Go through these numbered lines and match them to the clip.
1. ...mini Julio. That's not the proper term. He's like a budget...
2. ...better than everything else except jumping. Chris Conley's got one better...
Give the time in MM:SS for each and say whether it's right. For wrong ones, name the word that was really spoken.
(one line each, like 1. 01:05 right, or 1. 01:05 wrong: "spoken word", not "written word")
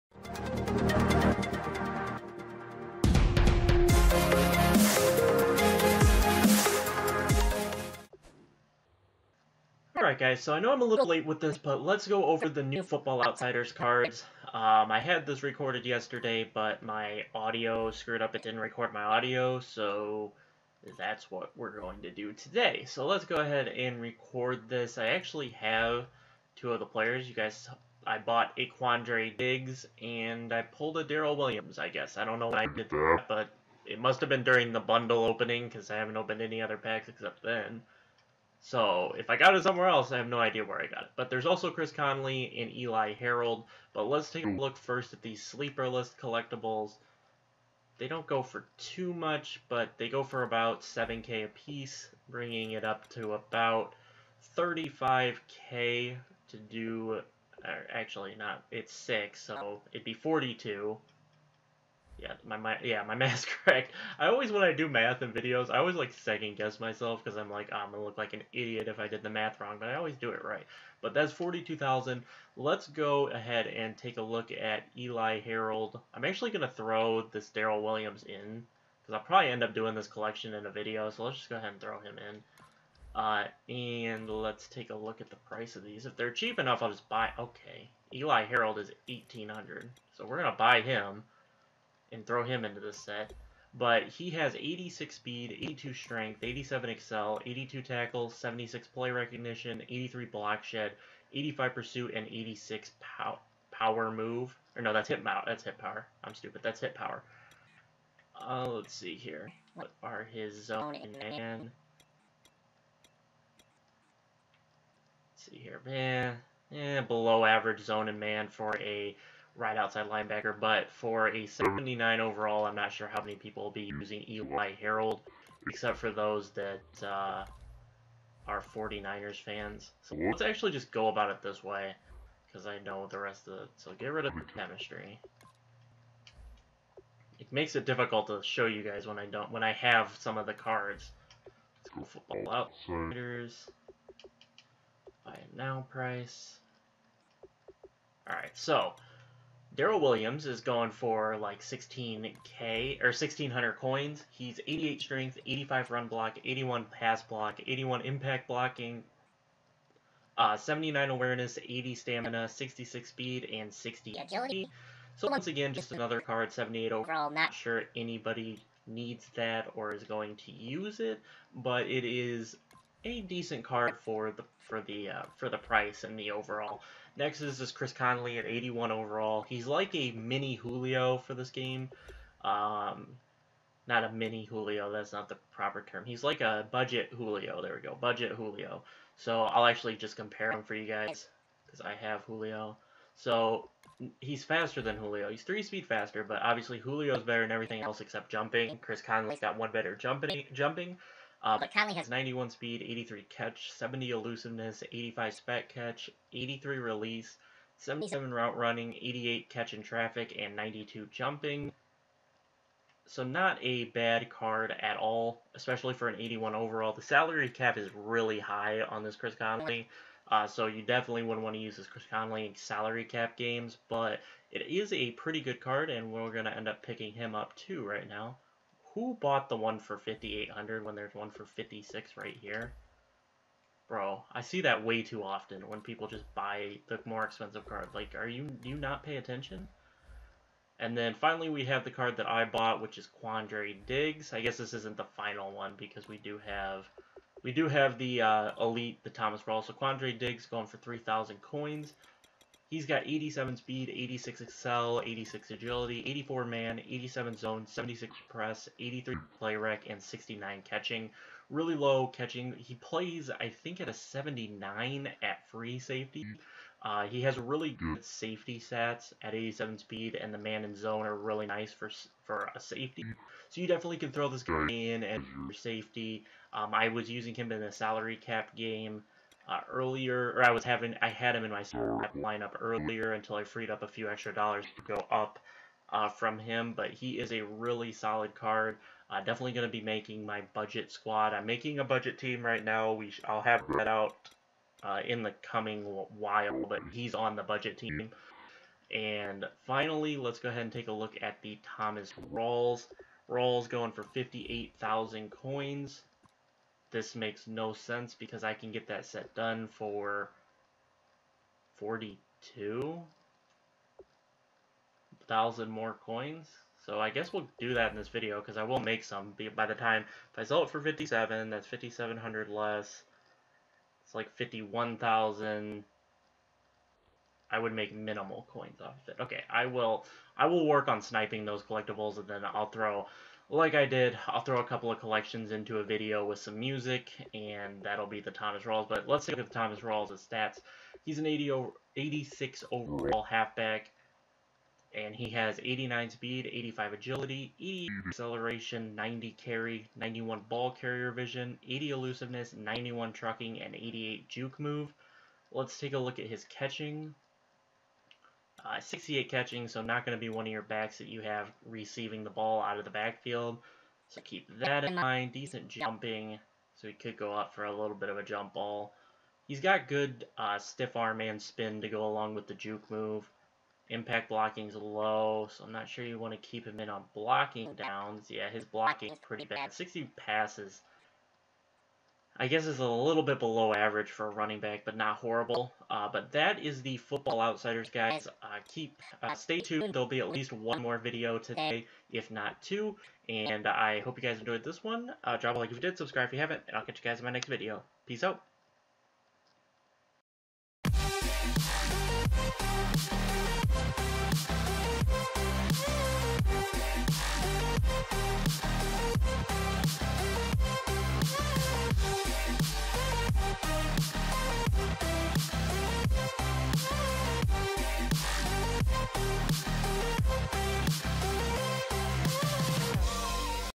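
1. 03:04 right
2. 03:17 right.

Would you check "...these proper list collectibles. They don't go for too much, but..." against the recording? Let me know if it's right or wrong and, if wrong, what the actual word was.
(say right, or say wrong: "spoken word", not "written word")
wrong: "sleeper", not "proper".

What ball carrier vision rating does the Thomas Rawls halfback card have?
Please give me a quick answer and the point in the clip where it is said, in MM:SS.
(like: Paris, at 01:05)
91, at 05:49.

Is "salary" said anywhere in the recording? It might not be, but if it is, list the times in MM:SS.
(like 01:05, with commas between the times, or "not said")
03:37, 03:42, 04:37.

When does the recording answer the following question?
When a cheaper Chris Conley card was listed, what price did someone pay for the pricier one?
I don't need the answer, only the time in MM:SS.
03:49.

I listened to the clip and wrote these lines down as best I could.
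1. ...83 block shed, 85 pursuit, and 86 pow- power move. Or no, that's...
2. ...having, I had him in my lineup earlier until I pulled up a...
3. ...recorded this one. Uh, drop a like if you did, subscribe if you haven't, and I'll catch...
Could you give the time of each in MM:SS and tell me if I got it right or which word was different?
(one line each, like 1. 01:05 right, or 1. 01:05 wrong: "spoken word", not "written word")
1. 01:39 right
2. 04:40 wrong: "freed", not "pulled"
3. 06:34 wrong: "enjoyed", not "recorded".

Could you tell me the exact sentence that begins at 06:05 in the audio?
Decent jumping, so he could go up for a little bit of a jump ball.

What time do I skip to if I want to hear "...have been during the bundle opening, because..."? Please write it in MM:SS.
00:34.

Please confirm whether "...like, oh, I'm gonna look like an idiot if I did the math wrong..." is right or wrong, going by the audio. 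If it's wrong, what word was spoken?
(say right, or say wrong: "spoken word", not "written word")
right.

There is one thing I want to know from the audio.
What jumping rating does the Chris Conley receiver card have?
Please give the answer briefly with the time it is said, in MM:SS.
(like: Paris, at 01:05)
92, at 03:30.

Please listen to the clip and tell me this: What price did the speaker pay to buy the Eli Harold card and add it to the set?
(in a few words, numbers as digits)
1,800.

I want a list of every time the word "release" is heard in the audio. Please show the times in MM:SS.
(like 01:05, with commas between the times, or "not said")
03:26.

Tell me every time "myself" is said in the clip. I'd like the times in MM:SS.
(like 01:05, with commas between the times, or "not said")
01:06.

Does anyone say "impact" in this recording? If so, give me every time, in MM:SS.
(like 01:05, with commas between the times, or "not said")
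02:38, 06:13.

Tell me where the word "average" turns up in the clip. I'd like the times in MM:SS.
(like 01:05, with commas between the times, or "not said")
01:57, 06:23.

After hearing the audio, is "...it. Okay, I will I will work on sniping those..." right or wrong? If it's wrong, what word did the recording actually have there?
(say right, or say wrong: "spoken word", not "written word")
right.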